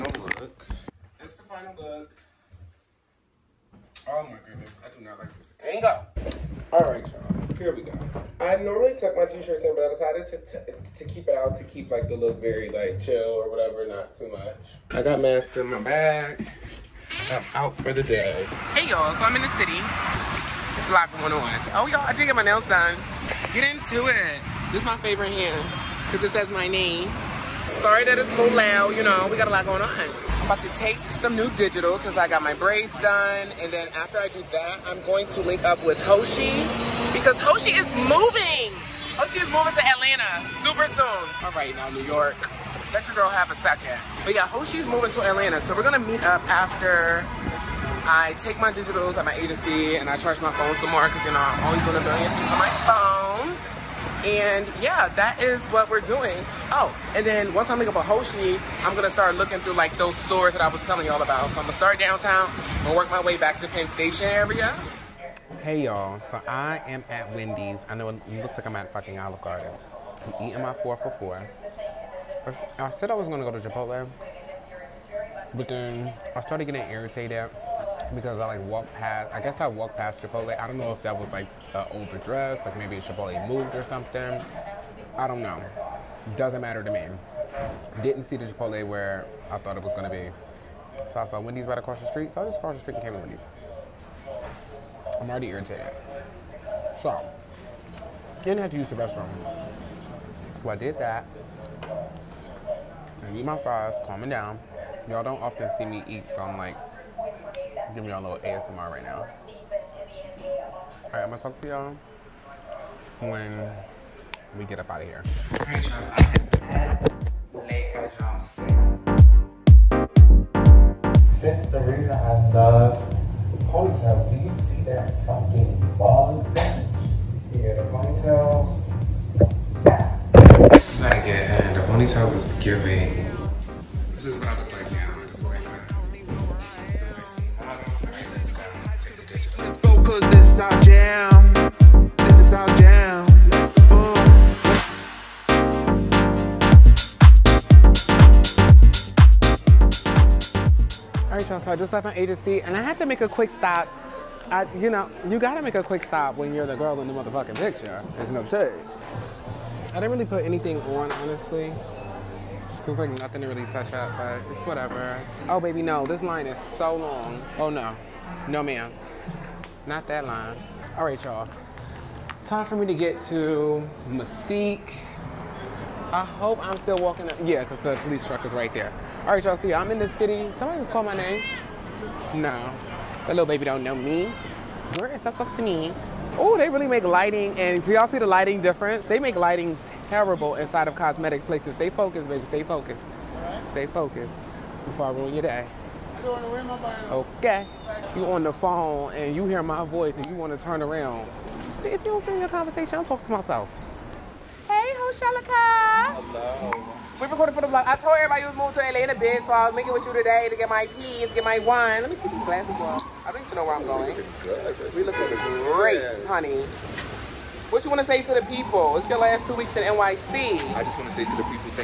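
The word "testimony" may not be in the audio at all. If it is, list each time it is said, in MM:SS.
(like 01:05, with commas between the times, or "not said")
not said.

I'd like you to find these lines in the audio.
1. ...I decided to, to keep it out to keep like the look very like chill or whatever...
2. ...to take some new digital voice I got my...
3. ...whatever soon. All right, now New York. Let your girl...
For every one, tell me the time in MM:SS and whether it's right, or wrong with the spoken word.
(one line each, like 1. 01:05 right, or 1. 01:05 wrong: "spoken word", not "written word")
1. 00:09 right
2. 00:30 wrong: "since", not "voice"
3. 00:40 wrong: "super", not "whatever".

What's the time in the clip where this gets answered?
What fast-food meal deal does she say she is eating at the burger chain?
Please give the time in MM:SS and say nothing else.
01:10.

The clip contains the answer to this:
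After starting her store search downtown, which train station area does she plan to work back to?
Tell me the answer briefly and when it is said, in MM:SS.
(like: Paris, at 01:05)
Penn Station, at 01:03.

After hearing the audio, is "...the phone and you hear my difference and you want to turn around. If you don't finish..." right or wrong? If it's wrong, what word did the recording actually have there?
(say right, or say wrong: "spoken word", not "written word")
wrong: "voice", not "difference".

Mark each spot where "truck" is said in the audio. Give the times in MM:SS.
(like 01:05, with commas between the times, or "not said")
02:58.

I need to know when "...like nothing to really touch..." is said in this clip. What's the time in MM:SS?
02:42.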